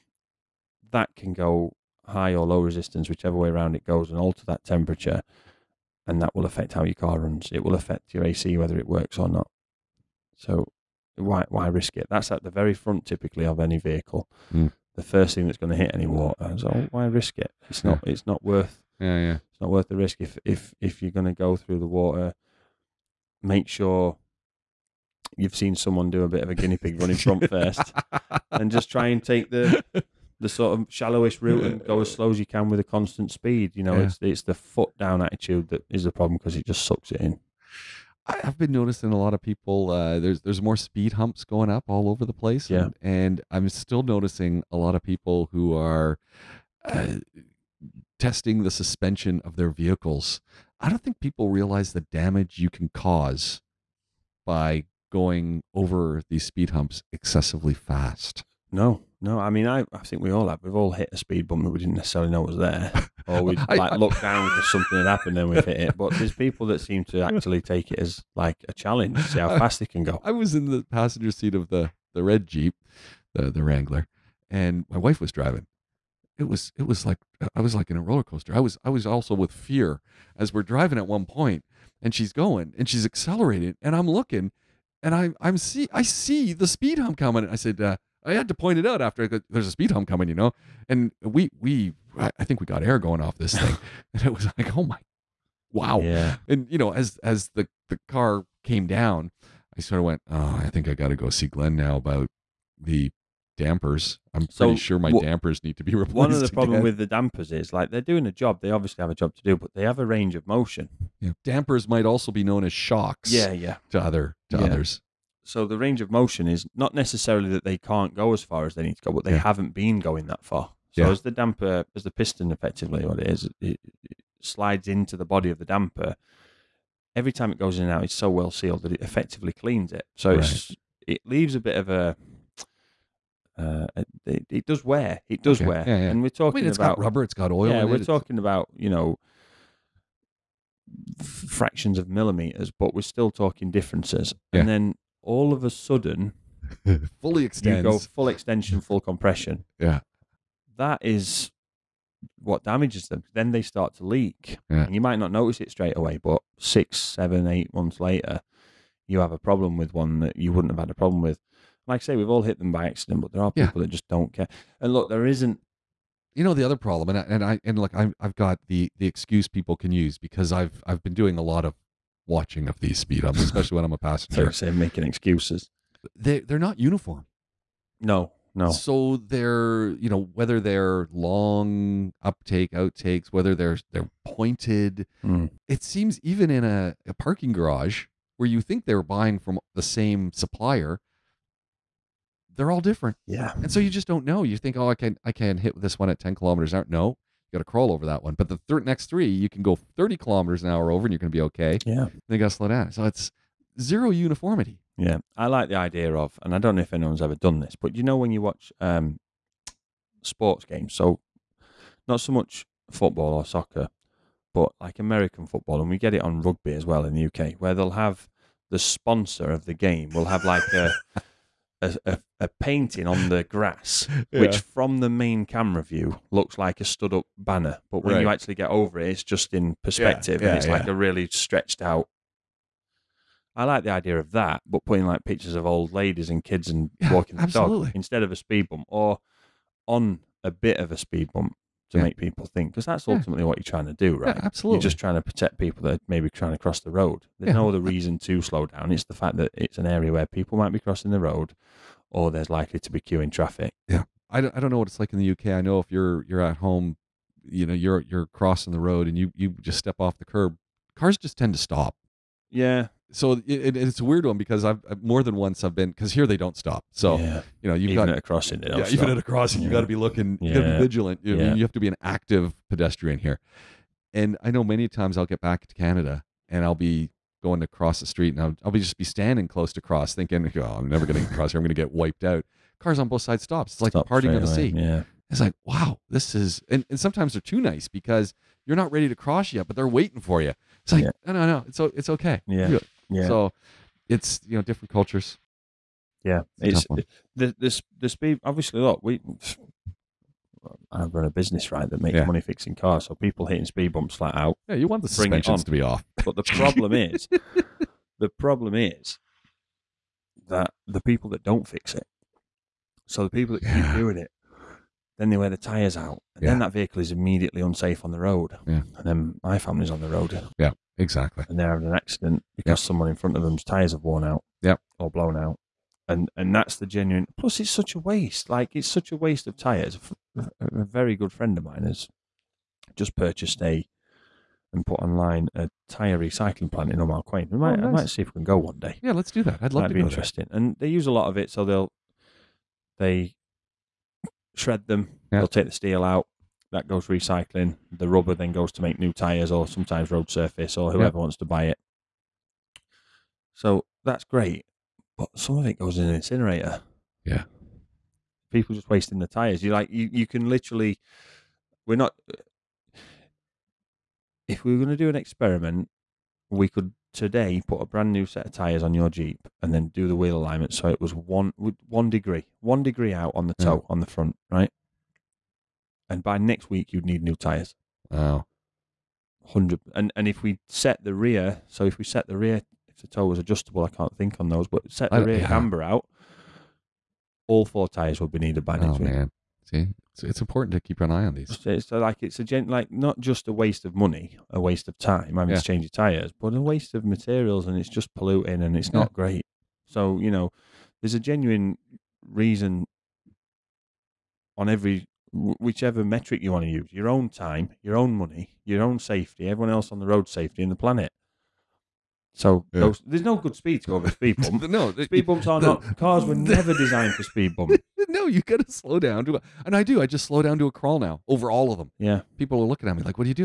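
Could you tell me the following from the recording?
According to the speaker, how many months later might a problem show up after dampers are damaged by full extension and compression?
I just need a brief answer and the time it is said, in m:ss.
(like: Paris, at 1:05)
6, 7, 8 months, at 2:36.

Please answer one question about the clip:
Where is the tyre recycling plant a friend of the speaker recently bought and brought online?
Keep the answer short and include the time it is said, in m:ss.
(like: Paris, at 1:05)
Omar Quain, at 5:37.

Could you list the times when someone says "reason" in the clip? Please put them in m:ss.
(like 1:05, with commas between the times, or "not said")
4:07, 6:42.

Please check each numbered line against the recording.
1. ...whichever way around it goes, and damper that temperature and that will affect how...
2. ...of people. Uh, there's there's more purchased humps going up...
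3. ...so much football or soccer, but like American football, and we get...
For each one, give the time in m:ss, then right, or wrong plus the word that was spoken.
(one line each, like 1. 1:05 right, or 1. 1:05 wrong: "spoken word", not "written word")
1. 0:03 wrong: "alter", not "damper"
2. 0:39 wrong: "speed", not "purchased"
3. 3:32 right.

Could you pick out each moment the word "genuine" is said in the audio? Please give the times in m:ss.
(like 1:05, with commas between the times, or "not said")
5:26, 6:41.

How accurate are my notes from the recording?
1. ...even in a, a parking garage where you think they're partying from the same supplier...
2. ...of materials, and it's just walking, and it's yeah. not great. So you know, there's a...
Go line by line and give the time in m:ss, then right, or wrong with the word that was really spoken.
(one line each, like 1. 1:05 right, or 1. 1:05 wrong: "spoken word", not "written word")
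1. 3:06 wrong: "buying", not "partying"
2. 6:36 wrong: "polluting", not "walking".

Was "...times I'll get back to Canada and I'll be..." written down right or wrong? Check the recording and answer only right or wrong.
right.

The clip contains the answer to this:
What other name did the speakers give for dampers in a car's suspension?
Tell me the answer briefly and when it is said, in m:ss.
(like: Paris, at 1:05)
Shocks, at 1:52.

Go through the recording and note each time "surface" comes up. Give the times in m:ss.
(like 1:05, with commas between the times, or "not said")
5:50.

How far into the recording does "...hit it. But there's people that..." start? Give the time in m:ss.
1:05.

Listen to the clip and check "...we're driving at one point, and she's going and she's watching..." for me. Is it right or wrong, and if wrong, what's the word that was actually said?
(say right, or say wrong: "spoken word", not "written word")
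wrong: "accelerating", not "watching".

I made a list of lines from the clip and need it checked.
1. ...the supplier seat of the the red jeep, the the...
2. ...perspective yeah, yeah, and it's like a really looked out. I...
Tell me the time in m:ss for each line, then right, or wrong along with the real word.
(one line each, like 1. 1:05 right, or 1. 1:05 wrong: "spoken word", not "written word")
1. 1:10 wrong: "passenger", not "supplier"
2. 3:49 wrong: "stretched", not "looked".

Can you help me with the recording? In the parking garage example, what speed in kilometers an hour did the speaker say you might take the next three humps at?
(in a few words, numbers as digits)
30 km/h.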